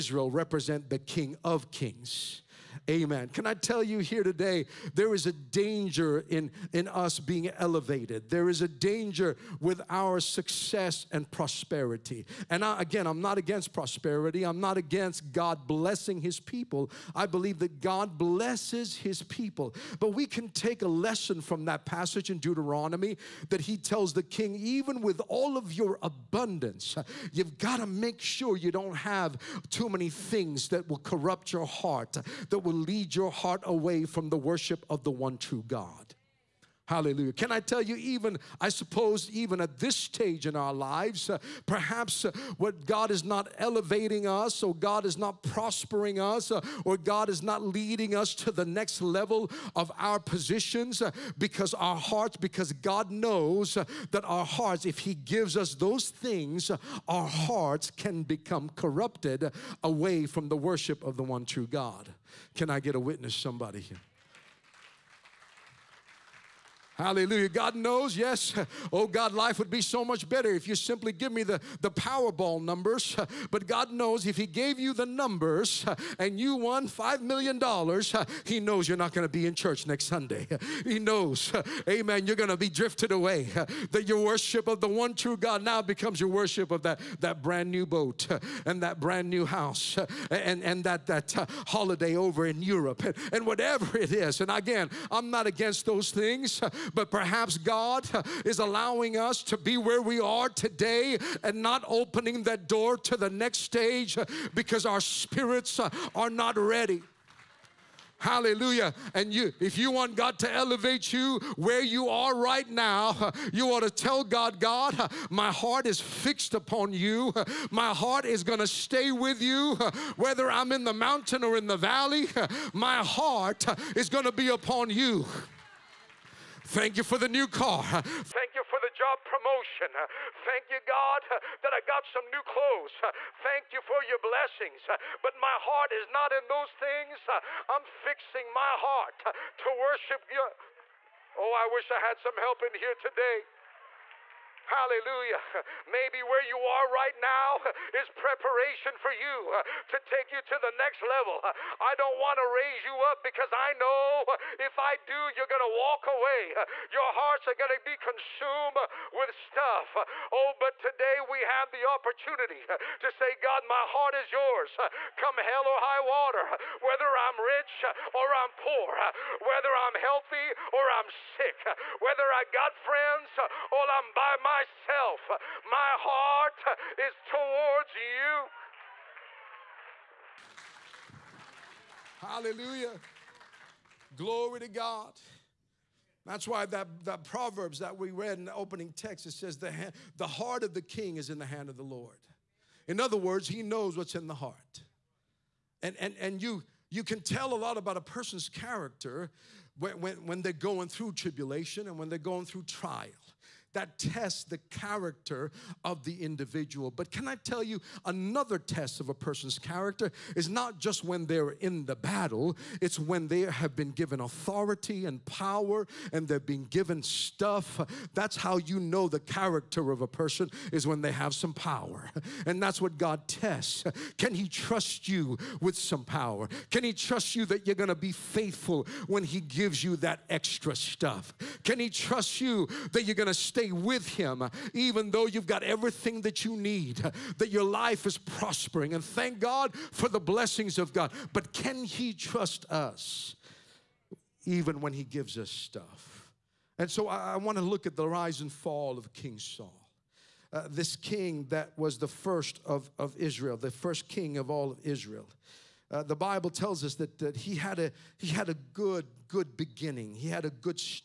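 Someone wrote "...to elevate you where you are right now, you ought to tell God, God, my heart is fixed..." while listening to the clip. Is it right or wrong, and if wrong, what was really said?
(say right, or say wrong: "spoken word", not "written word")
right.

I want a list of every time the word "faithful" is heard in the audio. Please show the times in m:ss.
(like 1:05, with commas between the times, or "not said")
3:48.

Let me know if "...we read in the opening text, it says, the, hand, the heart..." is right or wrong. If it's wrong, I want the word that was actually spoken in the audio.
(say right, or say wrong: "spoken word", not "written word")
right.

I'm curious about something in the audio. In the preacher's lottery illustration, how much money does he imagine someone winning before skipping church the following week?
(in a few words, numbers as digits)
$5 million.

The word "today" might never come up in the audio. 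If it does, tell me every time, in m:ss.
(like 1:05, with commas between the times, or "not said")
0:04, 1:40, 2:22, 2:40.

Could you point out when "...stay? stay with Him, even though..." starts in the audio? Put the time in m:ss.
3:53.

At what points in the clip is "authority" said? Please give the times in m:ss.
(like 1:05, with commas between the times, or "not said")
3:34.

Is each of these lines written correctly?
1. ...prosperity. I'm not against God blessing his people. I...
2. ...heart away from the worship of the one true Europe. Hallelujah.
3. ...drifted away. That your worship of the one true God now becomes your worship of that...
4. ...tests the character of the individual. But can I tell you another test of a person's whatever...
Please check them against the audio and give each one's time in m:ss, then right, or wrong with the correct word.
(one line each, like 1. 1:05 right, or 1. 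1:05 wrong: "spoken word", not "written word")
1. 0:13 right
2. 0:33 wrong: "God", not "Europe"
3. 1:22 right
4. 3:23 wrong: "character", not "whatever".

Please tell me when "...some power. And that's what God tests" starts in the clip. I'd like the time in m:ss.
3:41.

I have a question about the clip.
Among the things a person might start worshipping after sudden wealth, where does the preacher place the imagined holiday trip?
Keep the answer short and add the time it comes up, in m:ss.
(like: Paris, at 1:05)
Europe, at 1:32.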